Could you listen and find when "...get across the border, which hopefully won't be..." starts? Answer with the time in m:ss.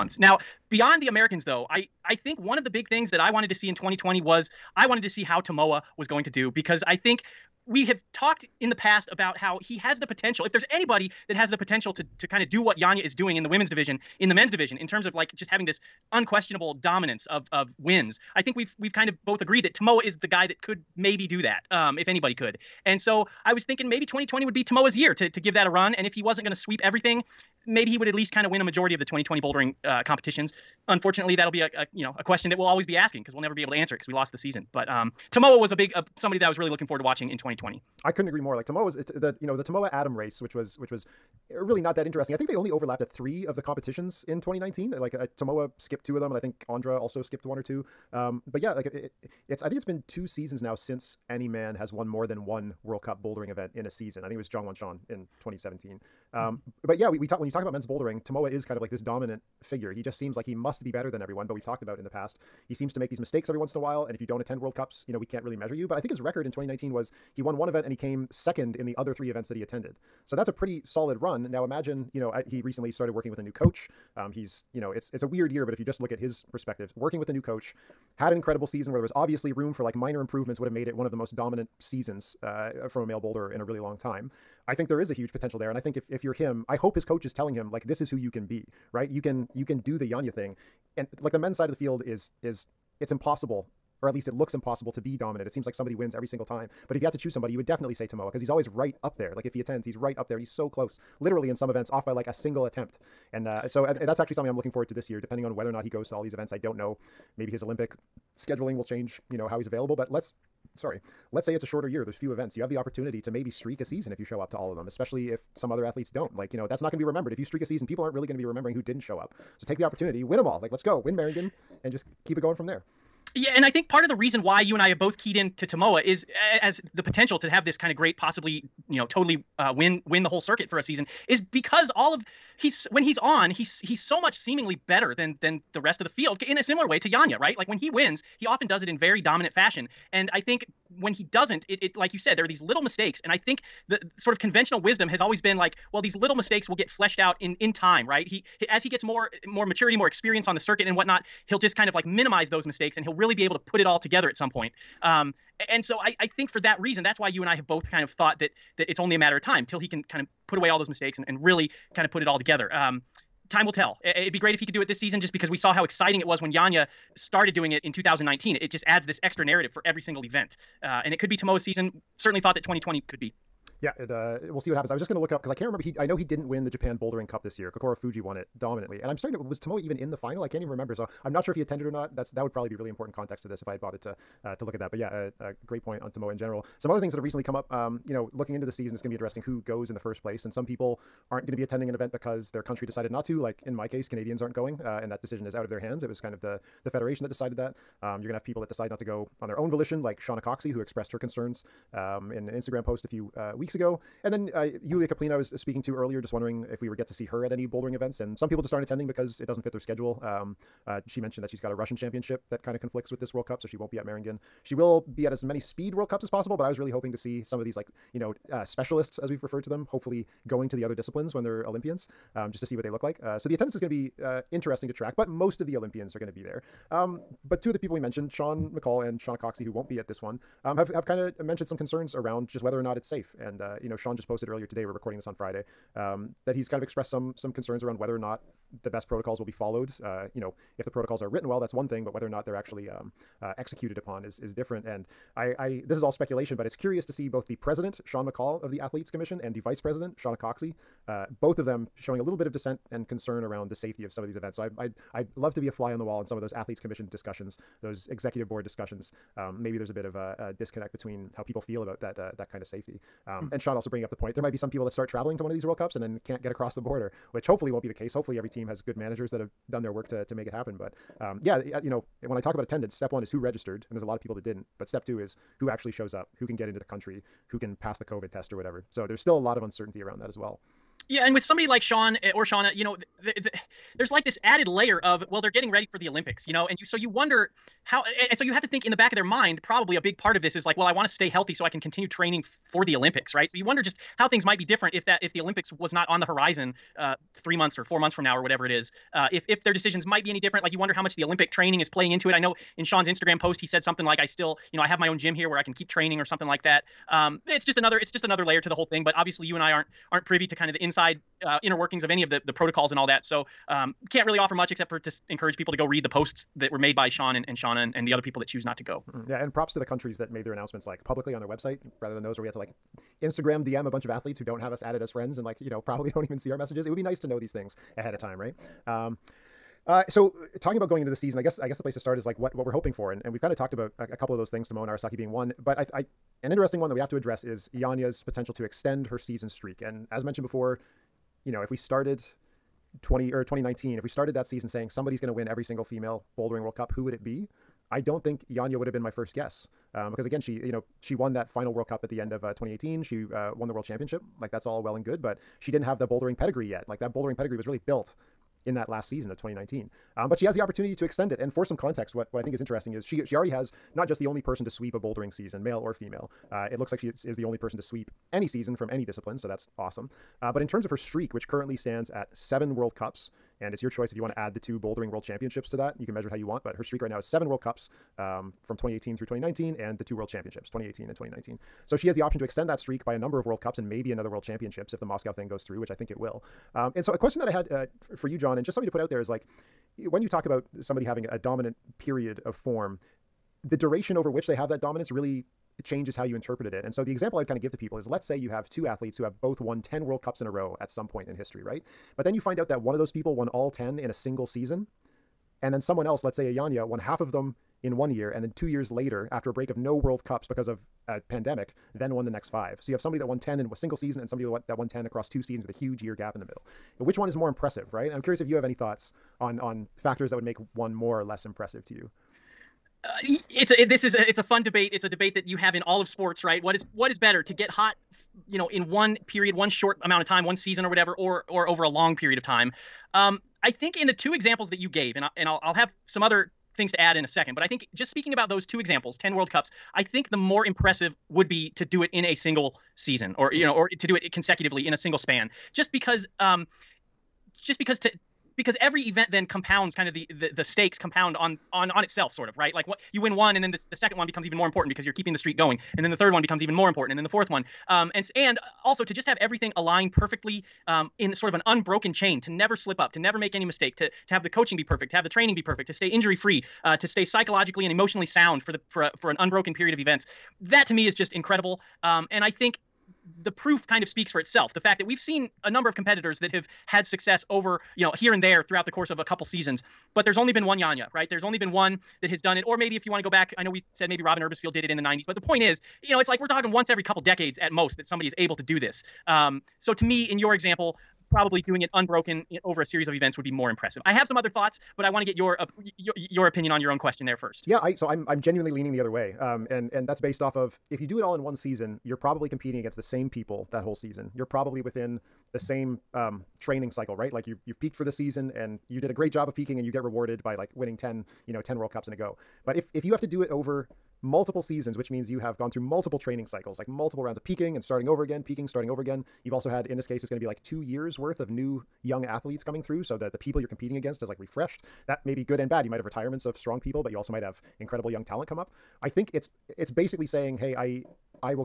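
4:26.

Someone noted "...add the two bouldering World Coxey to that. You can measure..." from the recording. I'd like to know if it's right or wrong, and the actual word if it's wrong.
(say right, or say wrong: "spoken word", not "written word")
wrong: "Championships", not "Coxey".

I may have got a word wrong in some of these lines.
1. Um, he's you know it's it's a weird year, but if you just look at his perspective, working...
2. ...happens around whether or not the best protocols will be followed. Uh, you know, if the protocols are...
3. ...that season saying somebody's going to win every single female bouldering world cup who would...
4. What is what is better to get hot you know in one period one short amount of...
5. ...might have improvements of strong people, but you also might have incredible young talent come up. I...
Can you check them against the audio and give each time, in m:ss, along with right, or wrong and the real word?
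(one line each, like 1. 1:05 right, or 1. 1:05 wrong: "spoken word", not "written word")
1. 1:14 right
2. 3:57 wrong: "concerns", not "happens"
3. 5:44 right
4. 7:06 right
5. 8:45 wrong: "retirements", not "improvements".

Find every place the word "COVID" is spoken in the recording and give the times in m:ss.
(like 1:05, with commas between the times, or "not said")
4:38.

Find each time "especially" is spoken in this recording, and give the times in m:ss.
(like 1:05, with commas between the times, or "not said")
1:54.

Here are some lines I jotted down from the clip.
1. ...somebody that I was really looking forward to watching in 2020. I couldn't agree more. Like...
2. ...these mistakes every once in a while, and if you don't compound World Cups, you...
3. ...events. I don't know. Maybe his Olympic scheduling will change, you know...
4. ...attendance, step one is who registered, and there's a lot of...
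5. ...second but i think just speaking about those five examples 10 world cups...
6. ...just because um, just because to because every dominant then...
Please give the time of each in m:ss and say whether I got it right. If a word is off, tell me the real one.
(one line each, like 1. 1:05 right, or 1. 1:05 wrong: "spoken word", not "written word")
1. 0:36 right
2. 1:03 wrong: "attend", not "compound"
3. 1:46 right
4. 4:32 right
5. 7:17 wrong: "two", not "five"
6. 7:25 wrong: "event", not "dominant".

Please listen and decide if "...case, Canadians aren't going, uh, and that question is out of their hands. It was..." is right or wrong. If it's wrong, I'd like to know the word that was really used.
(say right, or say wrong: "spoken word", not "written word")
wrong: "decision", not "question".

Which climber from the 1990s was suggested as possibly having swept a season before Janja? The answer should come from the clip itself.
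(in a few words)
Robyn Erbesfield.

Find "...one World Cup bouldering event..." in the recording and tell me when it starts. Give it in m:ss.
0:52.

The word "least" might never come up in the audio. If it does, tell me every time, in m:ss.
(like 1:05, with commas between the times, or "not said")
0:28, 1:34.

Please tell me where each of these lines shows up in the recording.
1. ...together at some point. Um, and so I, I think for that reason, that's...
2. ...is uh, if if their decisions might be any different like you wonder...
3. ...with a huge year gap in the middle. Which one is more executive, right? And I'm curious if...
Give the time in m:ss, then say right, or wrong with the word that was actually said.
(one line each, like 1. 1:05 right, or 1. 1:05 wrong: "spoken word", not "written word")
1. 2:33 right
2. 4:58 right
3. 6:55 wrong: "impressive", not "executive".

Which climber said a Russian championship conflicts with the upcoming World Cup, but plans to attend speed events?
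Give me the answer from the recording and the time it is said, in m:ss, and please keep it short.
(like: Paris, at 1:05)
Yulia Kaplina, at 3:24.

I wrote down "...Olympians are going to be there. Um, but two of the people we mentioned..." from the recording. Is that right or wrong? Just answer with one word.
right.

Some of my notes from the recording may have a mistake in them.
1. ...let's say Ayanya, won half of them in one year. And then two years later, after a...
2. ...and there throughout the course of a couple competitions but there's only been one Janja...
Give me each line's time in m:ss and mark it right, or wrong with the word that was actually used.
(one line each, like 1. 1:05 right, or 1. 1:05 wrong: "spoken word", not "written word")
1. 6:46 right
2. 7:58 wrong: "seasons", not "competitions".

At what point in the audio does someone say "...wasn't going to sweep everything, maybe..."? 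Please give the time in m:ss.
0:26.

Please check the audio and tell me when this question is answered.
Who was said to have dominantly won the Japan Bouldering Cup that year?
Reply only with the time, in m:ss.
2:57.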